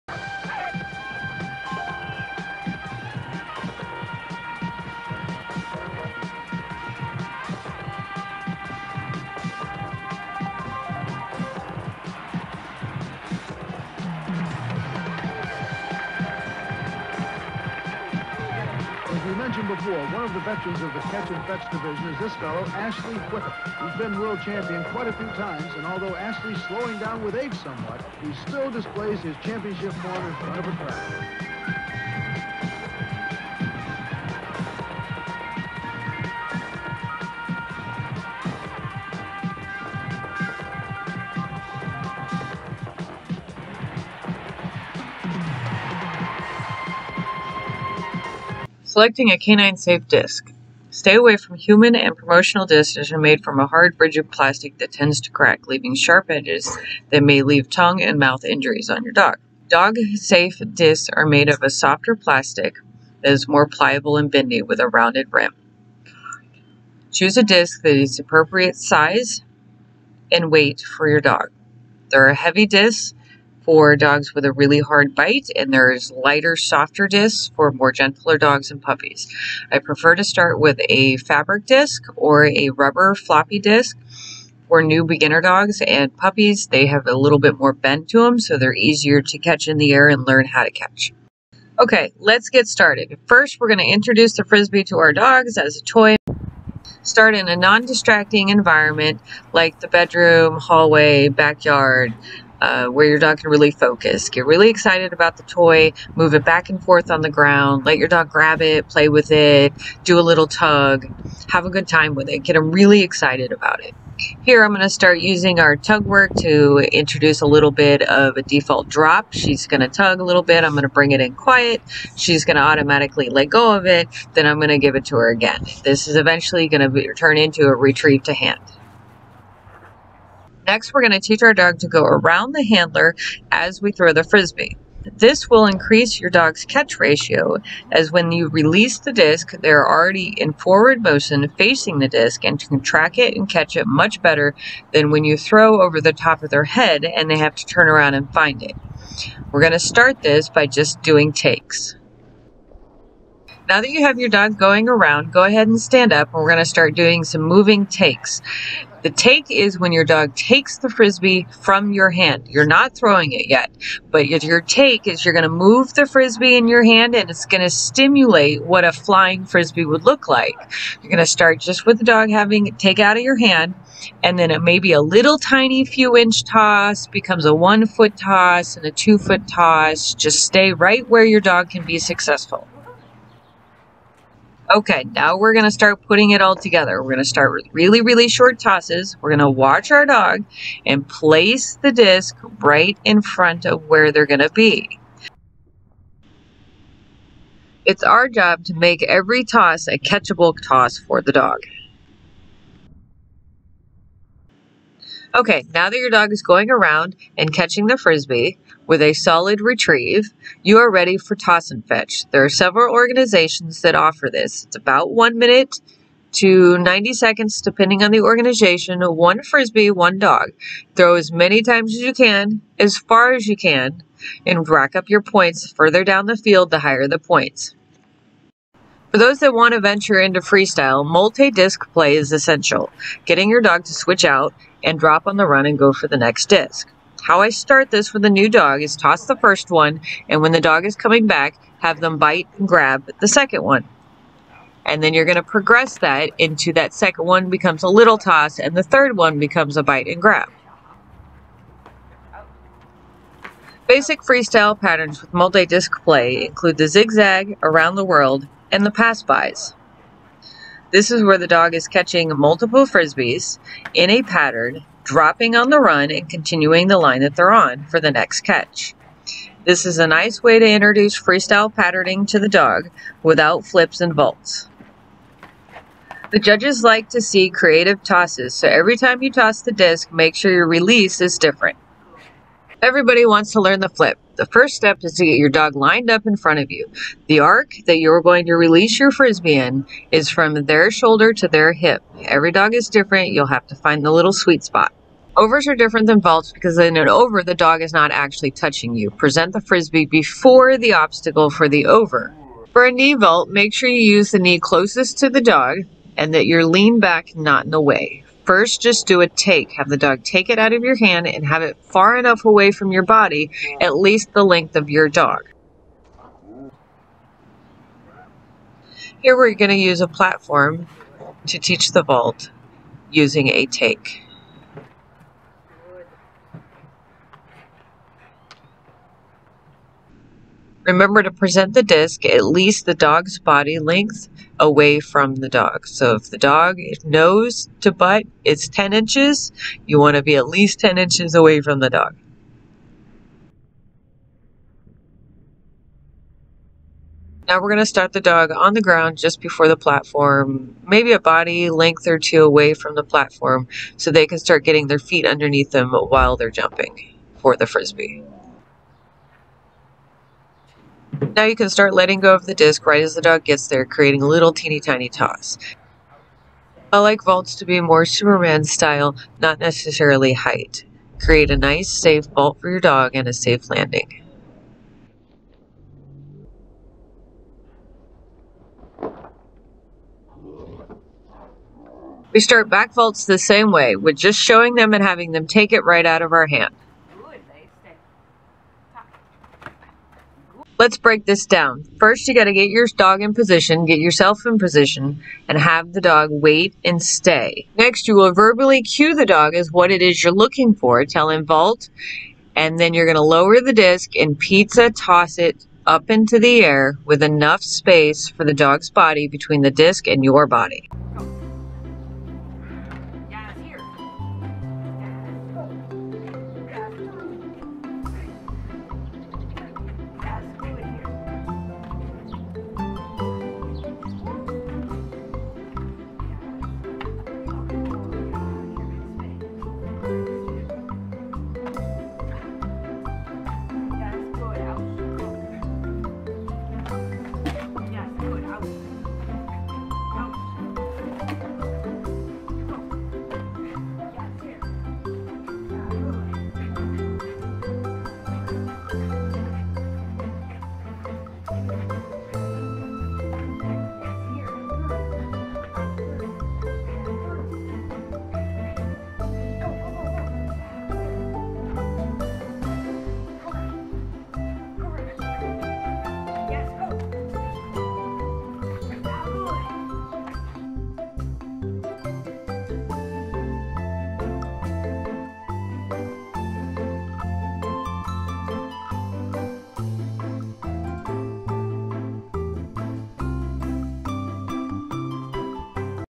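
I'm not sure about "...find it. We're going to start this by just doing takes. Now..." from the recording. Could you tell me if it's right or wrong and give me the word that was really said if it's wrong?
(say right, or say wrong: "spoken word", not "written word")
right.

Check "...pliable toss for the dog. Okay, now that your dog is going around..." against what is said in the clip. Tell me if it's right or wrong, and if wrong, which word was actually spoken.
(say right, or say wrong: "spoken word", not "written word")
wrong: "catchable", not "pliable".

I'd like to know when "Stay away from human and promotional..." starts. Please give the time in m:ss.
0:50.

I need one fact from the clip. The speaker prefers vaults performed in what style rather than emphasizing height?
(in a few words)
Superman style.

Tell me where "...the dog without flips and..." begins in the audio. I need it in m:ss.
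4:32.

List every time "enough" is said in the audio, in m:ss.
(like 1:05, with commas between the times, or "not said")
5:12, 6:47.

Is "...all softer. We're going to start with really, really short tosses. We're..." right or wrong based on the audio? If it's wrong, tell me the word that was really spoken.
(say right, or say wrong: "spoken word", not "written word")
wrong: "together", not "softer".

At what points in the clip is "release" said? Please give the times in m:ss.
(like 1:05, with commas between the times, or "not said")
2:18, 4:40, 4:48.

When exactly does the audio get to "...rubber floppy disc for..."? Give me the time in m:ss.
1:22.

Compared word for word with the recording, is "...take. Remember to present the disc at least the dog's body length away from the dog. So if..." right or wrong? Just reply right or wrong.
right.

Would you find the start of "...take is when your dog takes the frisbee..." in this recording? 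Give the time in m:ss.
2:39.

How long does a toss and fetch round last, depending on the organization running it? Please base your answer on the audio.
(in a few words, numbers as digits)
1 minute to 90 seconds.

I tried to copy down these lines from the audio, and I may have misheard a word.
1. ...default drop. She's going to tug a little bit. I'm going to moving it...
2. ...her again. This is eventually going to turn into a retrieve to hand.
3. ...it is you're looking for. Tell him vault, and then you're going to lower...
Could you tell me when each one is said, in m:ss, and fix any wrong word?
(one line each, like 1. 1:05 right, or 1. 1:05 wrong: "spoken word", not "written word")
1. 1:58 wrong: "bring", not "moving"
2. 2:05 right
3. 6:39 right.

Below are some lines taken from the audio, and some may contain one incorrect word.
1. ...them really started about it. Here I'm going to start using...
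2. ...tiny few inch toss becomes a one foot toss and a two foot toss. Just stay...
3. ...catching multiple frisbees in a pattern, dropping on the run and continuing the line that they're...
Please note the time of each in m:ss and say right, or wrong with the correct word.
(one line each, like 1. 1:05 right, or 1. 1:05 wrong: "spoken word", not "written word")
1. 1:52 wrong: "excited", not "started"
2. 2:55 right
3. 4:21 right.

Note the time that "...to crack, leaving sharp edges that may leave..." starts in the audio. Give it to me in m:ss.
0:55.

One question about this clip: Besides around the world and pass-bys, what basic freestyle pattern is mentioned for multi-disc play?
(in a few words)
Zigzag.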